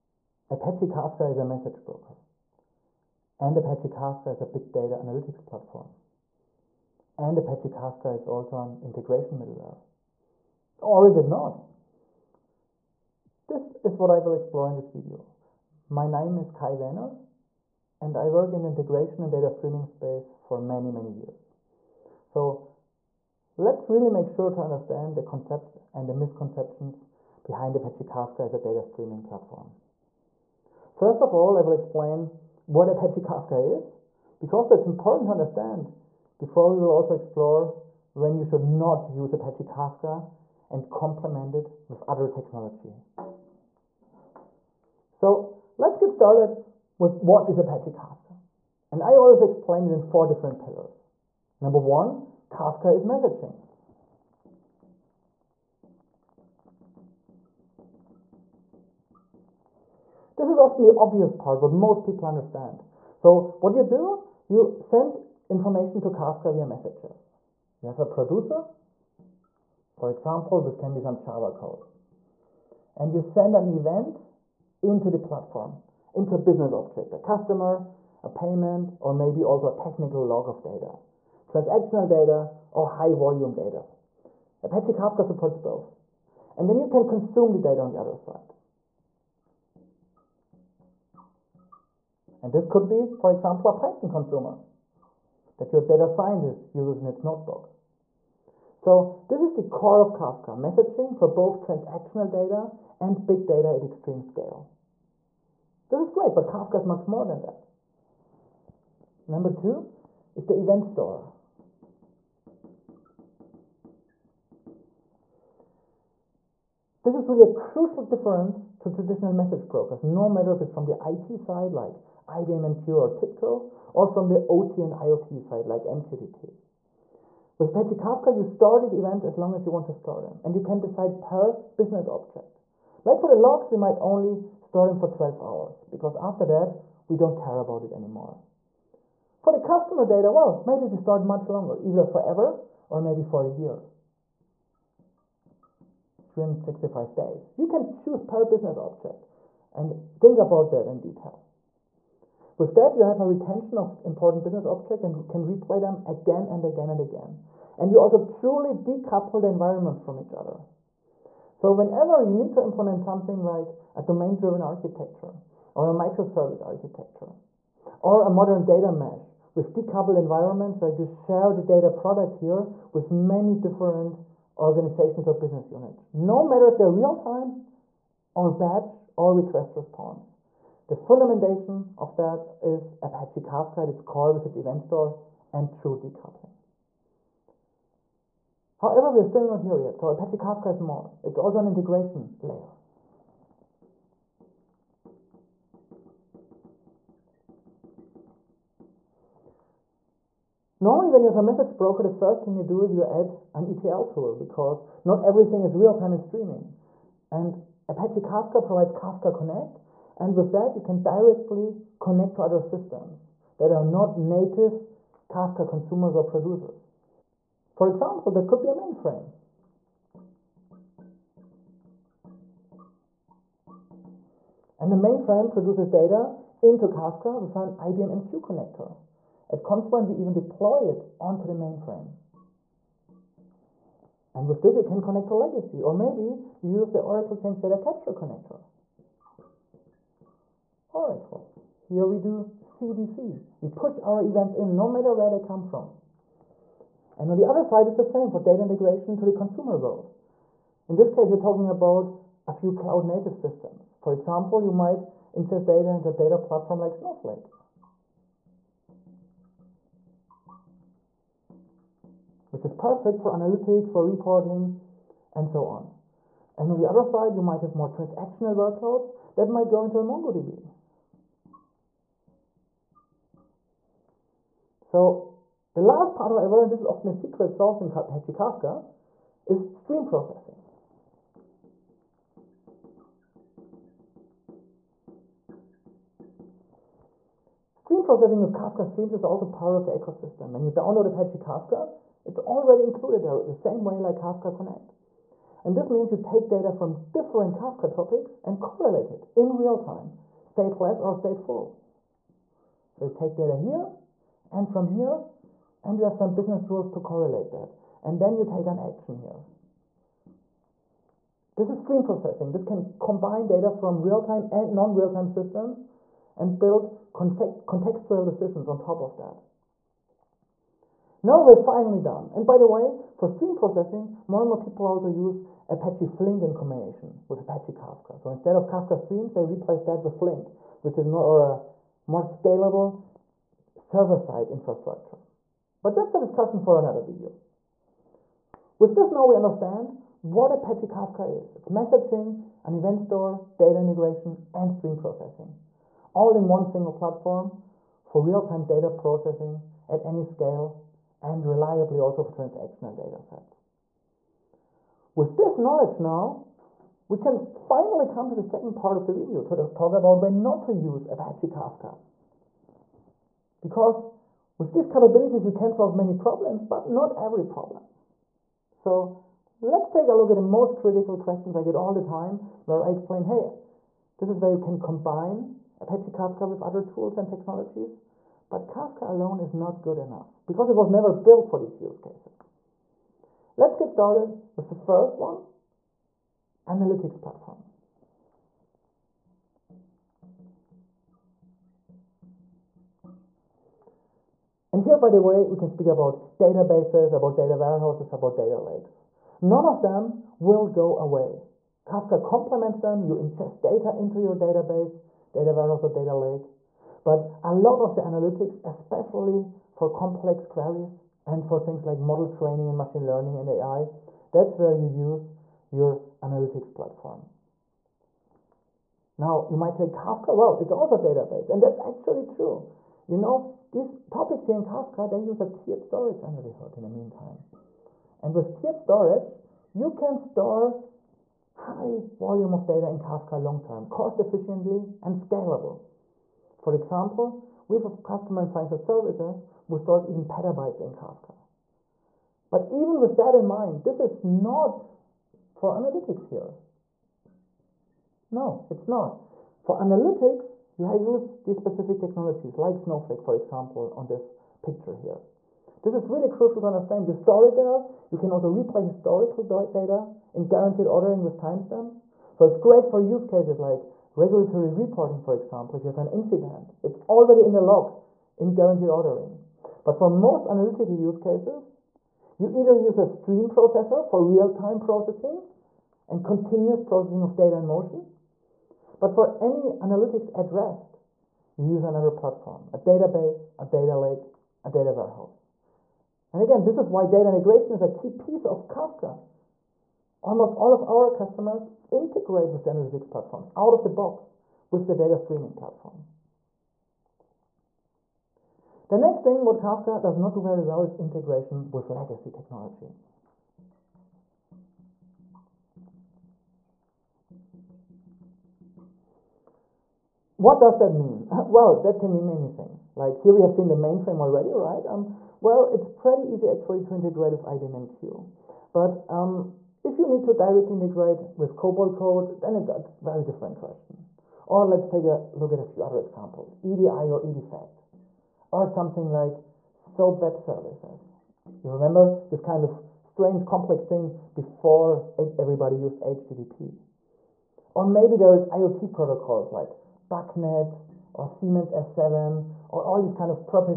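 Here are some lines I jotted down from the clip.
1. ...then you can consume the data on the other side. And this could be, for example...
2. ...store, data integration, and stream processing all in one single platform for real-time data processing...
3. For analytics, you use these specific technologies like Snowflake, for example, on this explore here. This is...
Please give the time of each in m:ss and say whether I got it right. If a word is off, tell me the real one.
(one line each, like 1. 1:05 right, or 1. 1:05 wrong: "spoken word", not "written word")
1. 1:26 right
2. 5:42 right
3. 7:29 wrong: "picture", not "explore".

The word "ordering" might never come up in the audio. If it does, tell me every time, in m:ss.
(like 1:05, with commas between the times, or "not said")
7:40, 7:48.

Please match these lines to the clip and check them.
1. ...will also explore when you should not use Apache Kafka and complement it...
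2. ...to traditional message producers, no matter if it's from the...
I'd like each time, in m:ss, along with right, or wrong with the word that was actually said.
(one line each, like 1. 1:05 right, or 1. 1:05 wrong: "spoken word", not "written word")
1. 0:36 right
2. 1:58 wrong: "brokers", not "producers".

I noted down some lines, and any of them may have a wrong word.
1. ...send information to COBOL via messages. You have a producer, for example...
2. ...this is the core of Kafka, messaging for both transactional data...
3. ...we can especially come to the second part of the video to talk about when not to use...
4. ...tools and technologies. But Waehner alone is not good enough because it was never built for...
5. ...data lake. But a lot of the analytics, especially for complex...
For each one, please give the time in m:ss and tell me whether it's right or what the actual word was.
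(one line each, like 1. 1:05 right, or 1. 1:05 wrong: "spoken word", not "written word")
1. 1:04 wrong: "Kafka", not "COBOL"
2. 1:39 right
3. 5:57 wrong: "finally", not "especially"
4. 6:16 wrong: "Kafka", not "Waehner"
5. 6:45 right.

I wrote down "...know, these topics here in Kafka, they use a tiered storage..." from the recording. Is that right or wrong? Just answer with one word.
right.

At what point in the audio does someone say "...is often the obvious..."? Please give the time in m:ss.
1:00.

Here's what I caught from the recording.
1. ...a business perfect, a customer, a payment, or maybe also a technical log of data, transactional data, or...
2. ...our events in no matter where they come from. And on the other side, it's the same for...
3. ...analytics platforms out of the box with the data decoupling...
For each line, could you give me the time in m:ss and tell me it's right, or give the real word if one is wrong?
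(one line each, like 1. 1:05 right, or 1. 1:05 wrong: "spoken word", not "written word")
1. 1:16 wrong: "object", not "perfect"
2. 4:04 right
3. 8:12 wrong: "streaming", not "decoupling".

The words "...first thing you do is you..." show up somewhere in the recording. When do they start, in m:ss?
3:22.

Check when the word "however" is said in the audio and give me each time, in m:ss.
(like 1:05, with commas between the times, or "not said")
3:08, 4:36.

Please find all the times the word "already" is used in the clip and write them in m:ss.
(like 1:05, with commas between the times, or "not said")
4:52, 7:47, 8:34.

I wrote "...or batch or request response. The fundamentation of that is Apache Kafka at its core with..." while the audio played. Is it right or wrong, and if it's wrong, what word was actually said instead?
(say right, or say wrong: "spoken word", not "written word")
right.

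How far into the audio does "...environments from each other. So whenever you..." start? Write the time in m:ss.
2:39.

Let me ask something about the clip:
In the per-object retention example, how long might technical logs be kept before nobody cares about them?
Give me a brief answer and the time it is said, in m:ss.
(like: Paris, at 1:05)
12 hours, at 2:15.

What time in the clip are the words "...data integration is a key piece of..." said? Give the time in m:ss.
8:07.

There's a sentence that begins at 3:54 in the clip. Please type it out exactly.
And with this, you can connect to legacy, or maybe you use the Oracle Change Data Capture connector.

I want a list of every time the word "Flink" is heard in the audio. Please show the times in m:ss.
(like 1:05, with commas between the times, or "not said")
5:26, 5:30.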